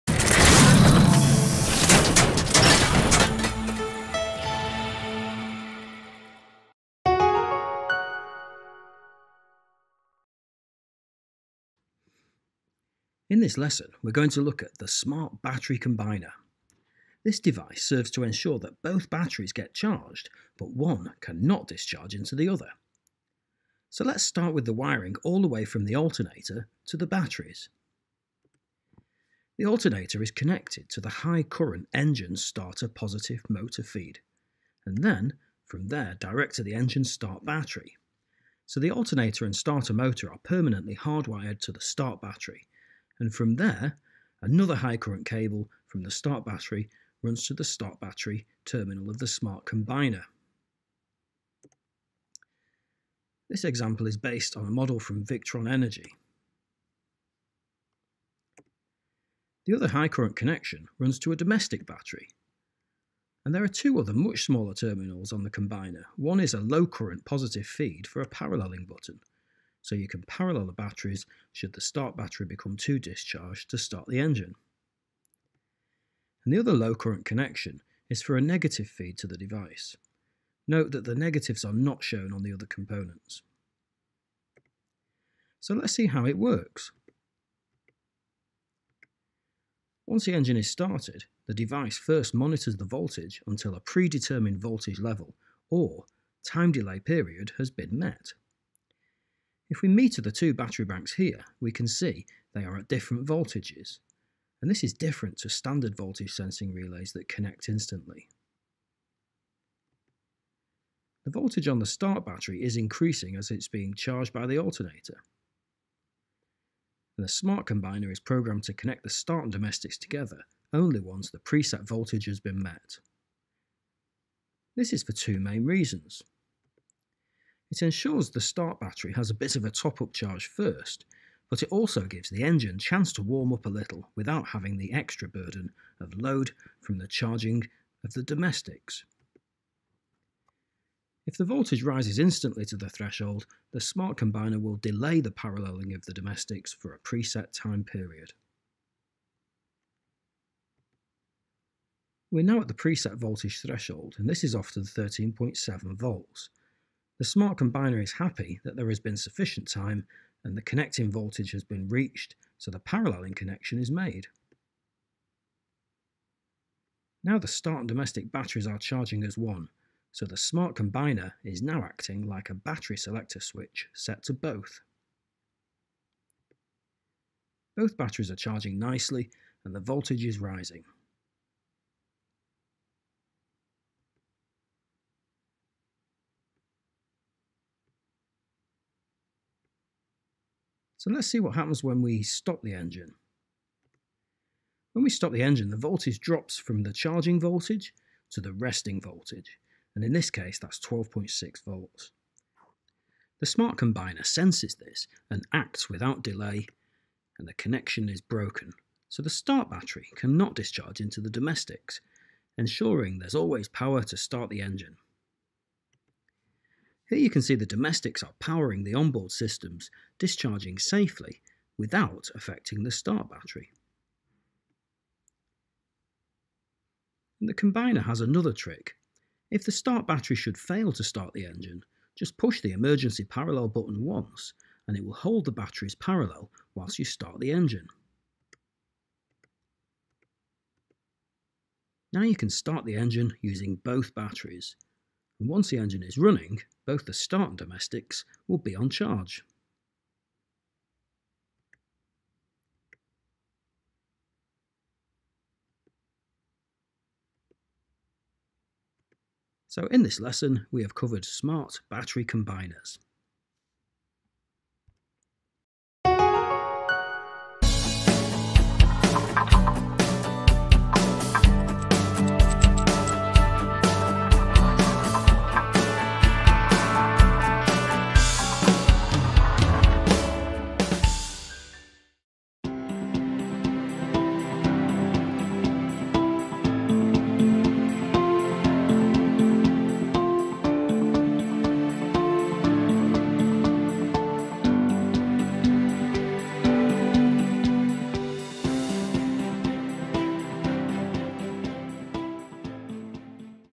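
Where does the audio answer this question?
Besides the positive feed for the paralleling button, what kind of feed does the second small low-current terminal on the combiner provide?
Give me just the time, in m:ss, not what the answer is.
1:18.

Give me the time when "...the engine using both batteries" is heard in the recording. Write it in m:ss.
4:02.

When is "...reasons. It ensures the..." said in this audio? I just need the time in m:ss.
2:05.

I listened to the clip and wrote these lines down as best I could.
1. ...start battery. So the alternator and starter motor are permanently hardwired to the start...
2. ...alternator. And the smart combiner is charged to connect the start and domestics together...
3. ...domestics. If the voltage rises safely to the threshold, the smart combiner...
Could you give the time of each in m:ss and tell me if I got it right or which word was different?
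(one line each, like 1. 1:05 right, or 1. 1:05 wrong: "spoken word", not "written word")
1. 0:37 right
2. 1:54 wrong: "programmed", not "charged"
3. 2:18 wrong: "instantly", not "safely".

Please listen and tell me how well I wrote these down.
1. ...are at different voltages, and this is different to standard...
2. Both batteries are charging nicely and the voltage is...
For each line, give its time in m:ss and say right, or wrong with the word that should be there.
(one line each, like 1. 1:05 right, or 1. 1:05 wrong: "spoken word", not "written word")
1. 1:42 right
2. 2:57 right.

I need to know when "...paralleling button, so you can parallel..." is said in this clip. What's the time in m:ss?
1:08.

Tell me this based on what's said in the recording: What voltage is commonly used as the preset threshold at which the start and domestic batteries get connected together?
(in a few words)
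13.7 volts.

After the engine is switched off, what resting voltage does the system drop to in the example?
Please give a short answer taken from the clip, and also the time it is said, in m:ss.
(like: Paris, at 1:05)
12.6 volts, at 3:20.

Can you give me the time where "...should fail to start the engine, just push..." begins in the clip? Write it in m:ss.
3:50.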